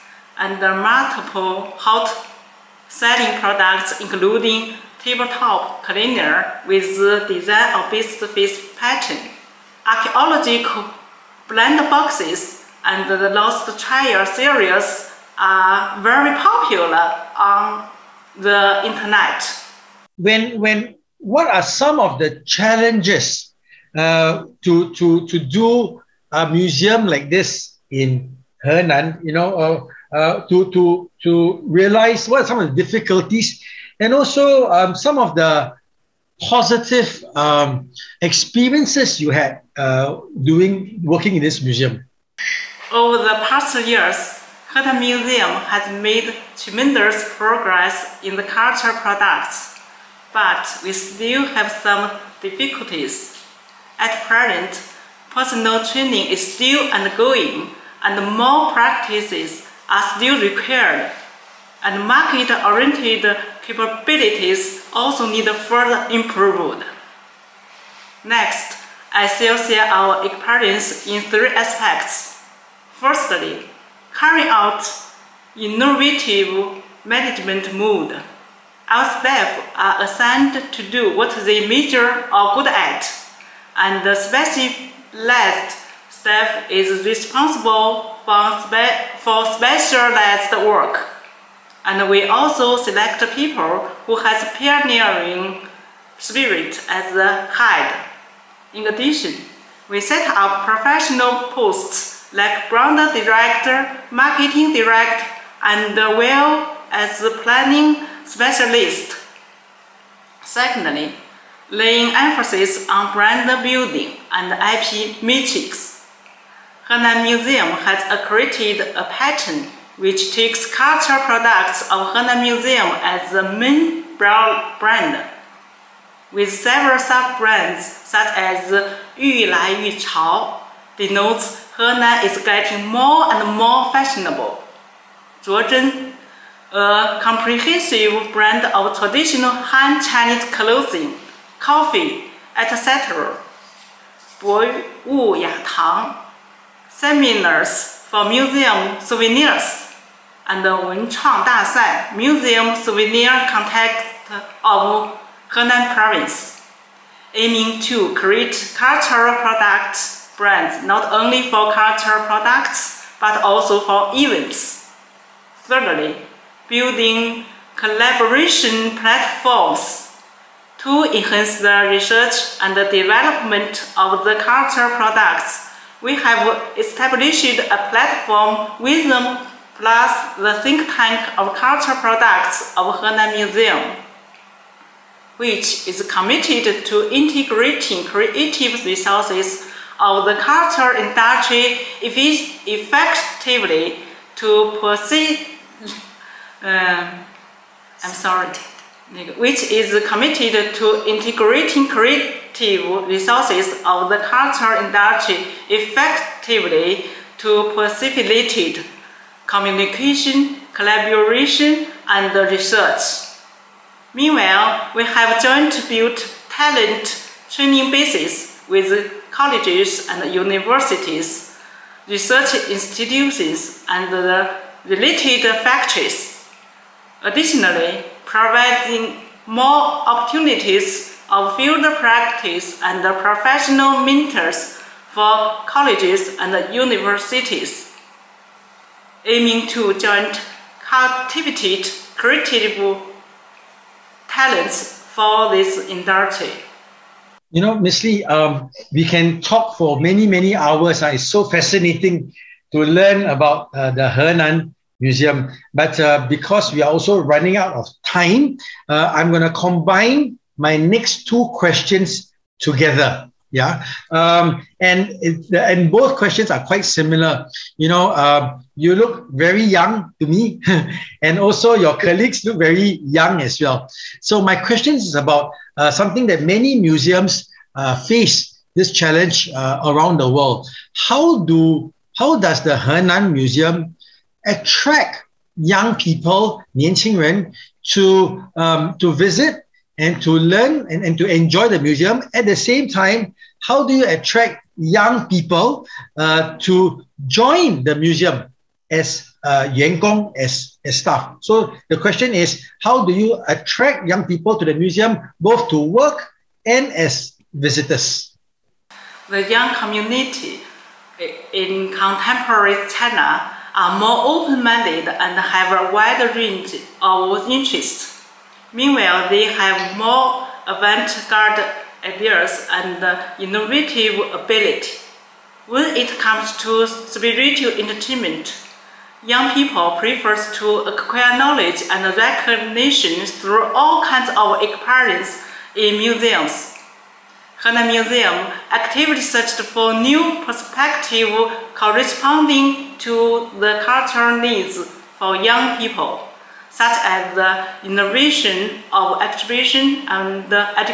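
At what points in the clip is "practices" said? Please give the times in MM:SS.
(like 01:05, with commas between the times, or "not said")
00:58, 03:52.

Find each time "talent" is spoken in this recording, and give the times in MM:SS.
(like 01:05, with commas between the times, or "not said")
03:36, 04:04.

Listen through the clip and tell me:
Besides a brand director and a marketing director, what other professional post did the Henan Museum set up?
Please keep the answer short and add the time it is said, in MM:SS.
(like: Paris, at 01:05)
Planning specialist, at 01:47.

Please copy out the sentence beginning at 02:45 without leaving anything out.
Thirdly, building collaboration platforms to enhance the research and the development of the culture products.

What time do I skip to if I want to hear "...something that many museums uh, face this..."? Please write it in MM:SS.
04:35.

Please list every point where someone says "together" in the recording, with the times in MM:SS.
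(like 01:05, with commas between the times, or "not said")
04:22.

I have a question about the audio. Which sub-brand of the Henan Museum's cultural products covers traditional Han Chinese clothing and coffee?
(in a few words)
Zhuozhen.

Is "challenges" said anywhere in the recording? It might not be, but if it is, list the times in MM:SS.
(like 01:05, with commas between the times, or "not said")
00:22, 04:38.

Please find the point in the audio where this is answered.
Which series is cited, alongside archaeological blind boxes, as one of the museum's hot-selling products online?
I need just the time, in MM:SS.
00:13.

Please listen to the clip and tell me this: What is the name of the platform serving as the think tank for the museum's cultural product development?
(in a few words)
Wisdom Plus.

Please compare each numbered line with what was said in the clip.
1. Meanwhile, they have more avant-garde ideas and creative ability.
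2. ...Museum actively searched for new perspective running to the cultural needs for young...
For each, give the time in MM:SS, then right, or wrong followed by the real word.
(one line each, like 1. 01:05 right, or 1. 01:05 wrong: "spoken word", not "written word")
1. 05:18 wrong: "innovative", not "creative"
2. 05:37 wrong: "corresponding", not "running".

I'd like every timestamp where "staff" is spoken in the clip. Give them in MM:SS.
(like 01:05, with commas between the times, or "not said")
01:19, 01:26, 05:00.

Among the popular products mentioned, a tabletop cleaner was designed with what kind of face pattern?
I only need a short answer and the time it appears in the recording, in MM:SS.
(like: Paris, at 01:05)
Beast face, at 00:07.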